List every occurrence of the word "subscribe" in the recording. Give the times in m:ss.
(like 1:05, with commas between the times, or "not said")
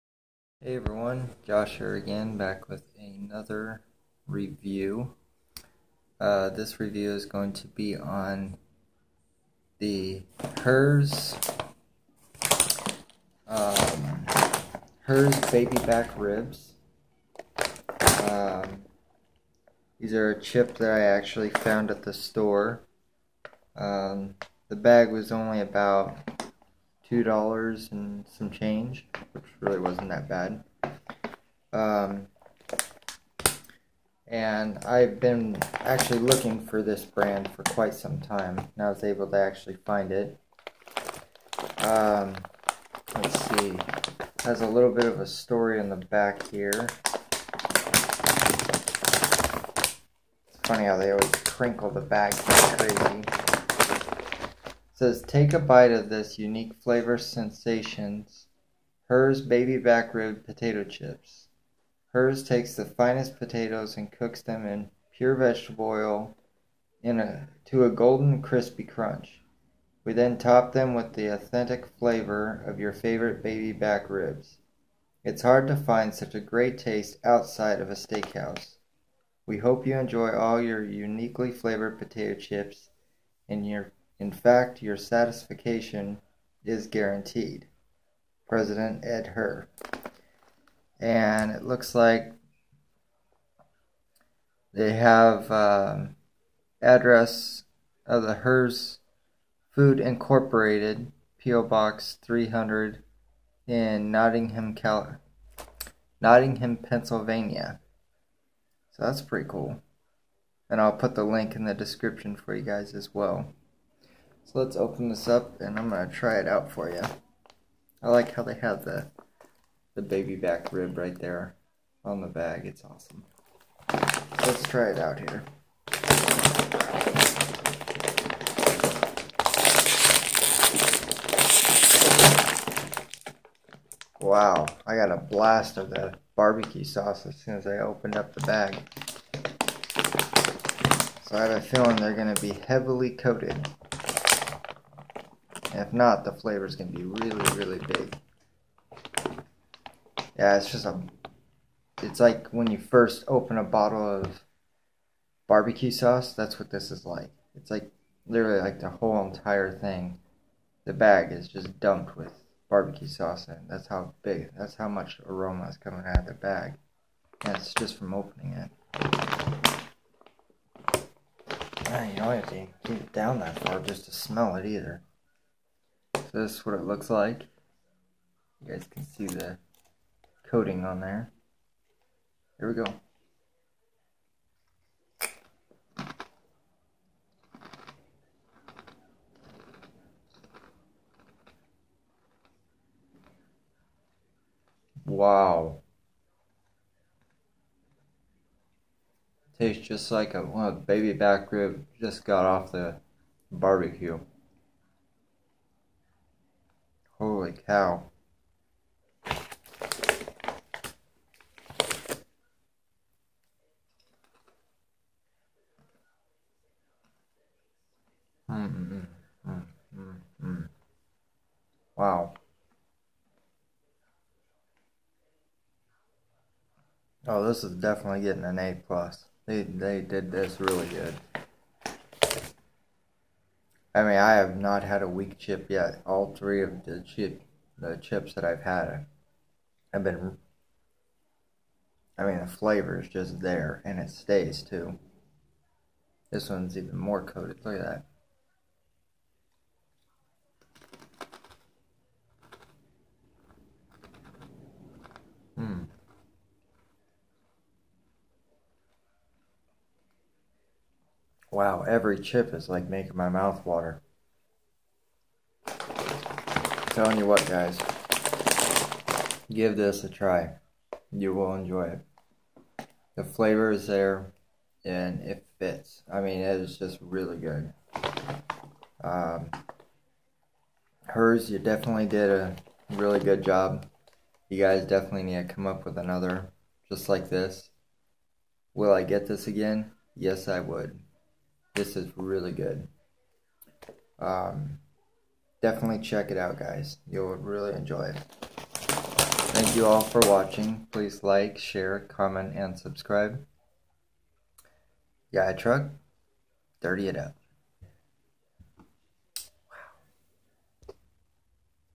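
5:02.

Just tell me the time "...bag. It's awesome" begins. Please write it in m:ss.
2:02.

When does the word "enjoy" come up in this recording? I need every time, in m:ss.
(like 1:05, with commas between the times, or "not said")
1:19, 4:31, 4:57.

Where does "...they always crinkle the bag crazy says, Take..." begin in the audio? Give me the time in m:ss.
0:50.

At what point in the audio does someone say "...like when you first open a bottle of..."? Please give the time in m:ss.
2:32.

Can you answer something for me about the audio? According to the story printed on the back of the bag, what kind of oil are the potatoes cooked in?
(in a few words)
pure vegetable oil.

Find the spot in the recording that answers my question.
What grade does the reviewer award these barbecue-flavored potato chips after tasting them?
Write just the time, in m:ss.
3:48.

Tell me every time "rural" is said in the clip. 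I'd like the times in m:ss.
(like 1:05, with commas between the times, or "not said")
not said.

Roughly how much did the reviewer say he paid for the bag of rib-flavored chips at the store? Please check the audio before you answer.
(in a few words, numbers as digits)
2 dollars and some change.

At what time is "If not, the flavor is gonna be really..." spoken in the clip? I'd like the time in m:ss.
2:25.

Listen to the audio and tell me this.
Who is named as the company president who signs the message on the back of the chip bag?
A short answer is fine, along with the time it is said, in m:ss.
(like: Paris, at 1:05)
Ed Herr, at 1:29.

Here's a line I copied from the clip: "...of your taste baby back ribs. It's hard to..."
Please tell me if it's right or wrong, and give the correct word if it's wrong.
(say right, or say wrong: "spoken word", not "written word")
wrong: "favorite", not "taste".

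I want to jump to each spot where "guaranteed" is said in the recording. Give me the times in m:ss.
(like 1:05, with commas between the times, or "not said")
1:26.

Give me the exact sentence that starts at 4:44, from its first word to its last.
You guys definitely need to come up with another just like this.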